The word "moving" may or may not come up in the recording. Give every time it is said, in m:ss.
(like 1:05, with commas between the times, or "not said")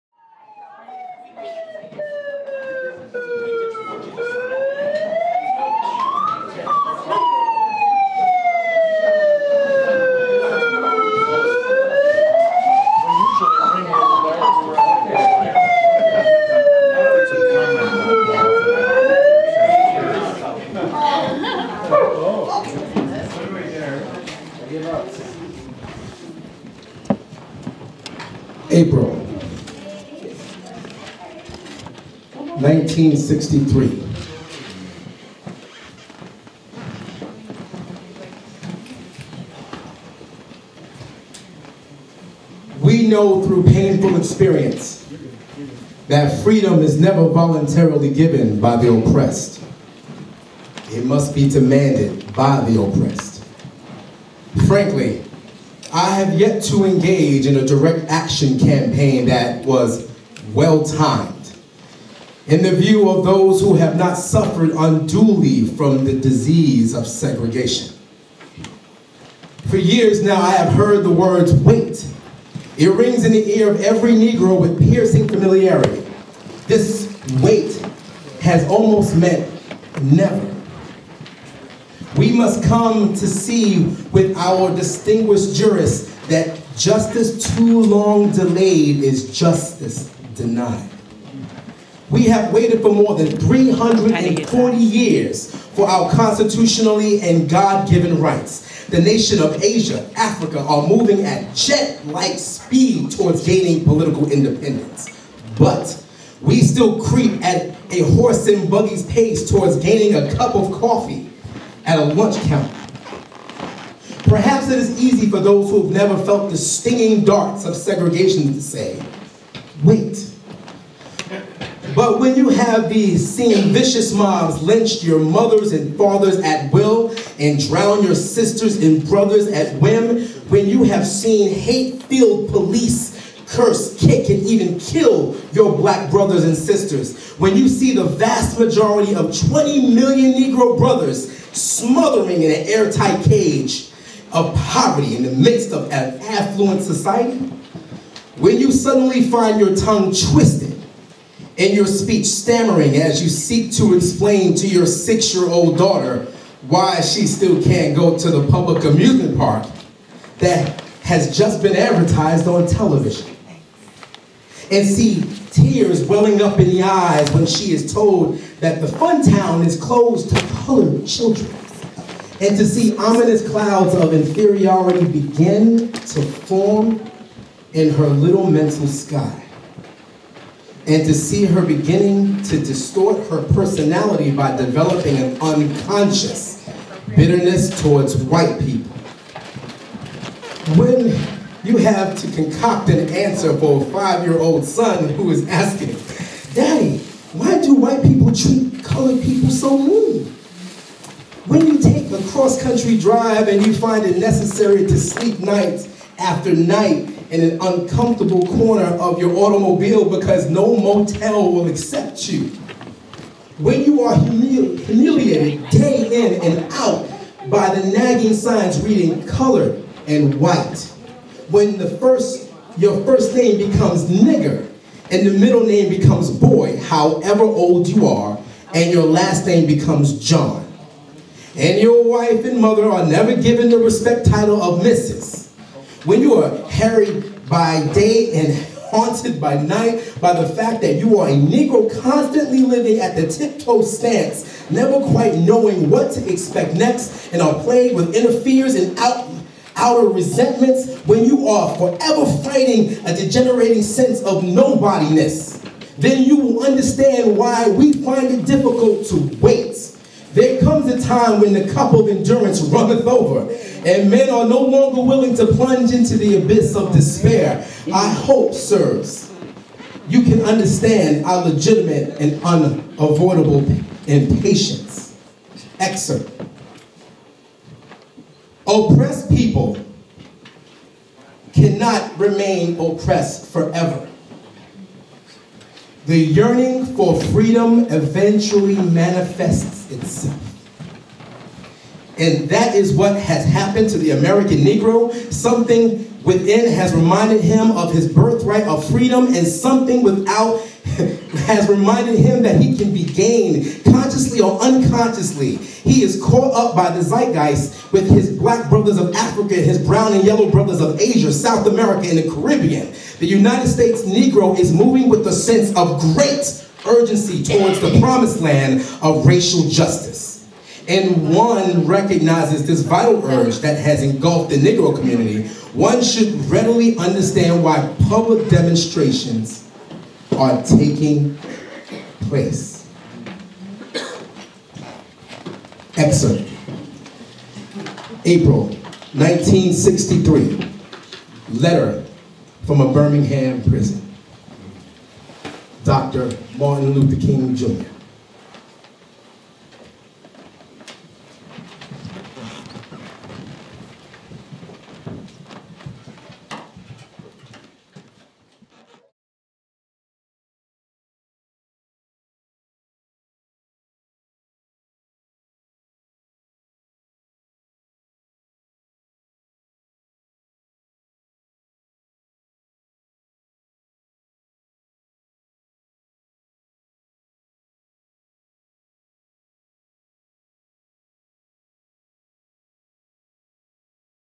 1:40, 5:14.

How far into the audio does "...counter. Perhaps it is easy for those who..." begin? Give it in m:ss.
1:52.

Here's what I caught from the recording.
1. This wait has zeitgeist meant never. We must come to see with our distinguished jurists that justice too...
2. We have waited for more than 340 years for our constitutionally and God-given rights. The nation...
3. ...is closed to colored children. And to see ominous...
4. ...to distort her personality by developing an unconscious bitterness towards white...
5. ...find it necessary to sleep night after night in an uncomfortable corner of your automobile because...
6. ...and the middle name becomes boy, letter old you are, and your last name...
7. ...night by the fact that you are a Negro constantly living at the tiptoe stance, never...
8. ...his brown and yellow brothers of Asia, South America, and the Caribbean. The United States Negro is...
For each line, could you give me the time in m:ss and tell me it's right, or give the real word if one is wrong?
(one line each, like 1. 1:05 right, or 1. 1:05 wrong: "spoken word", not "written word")
1. 1:16 wrong: "almost", not "zeitgeist"
2. 1:32 right
3. 2:49 right
4. 3:02 right
5. 3:23 right
6. 3:45 wrong: "however", not "letter"
7. 3:59 right
8. 5:09 right.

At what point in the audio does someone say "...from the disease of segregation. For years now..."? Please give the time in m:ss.
1:05.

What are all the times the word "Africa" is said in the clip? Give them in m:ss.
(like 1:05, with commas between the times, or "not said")
1:40, 5:09.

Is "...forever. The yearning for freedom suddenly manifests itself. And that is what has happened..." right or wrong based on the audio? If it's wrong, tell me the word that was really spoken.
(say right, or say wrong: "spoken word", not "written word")
wrong: "eventually", not "suddenly".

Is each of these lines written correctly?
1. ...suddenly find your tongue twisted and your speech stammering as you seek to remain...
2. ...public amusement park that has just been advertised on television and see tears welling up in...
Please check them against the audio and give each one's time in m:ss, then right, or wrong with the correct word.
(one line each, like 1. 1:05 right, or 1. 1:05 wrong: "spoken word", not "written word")
1. 2:28 wrong: "explain", not "remain"
2. 2:38 right.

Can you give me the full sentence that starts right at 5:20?
And one recognizes this vital urge that has engulfed the Negro community, one should readily understand why public demonstrations are taking place.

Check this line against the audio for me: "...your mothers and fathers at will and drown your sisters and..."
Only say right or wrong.
right.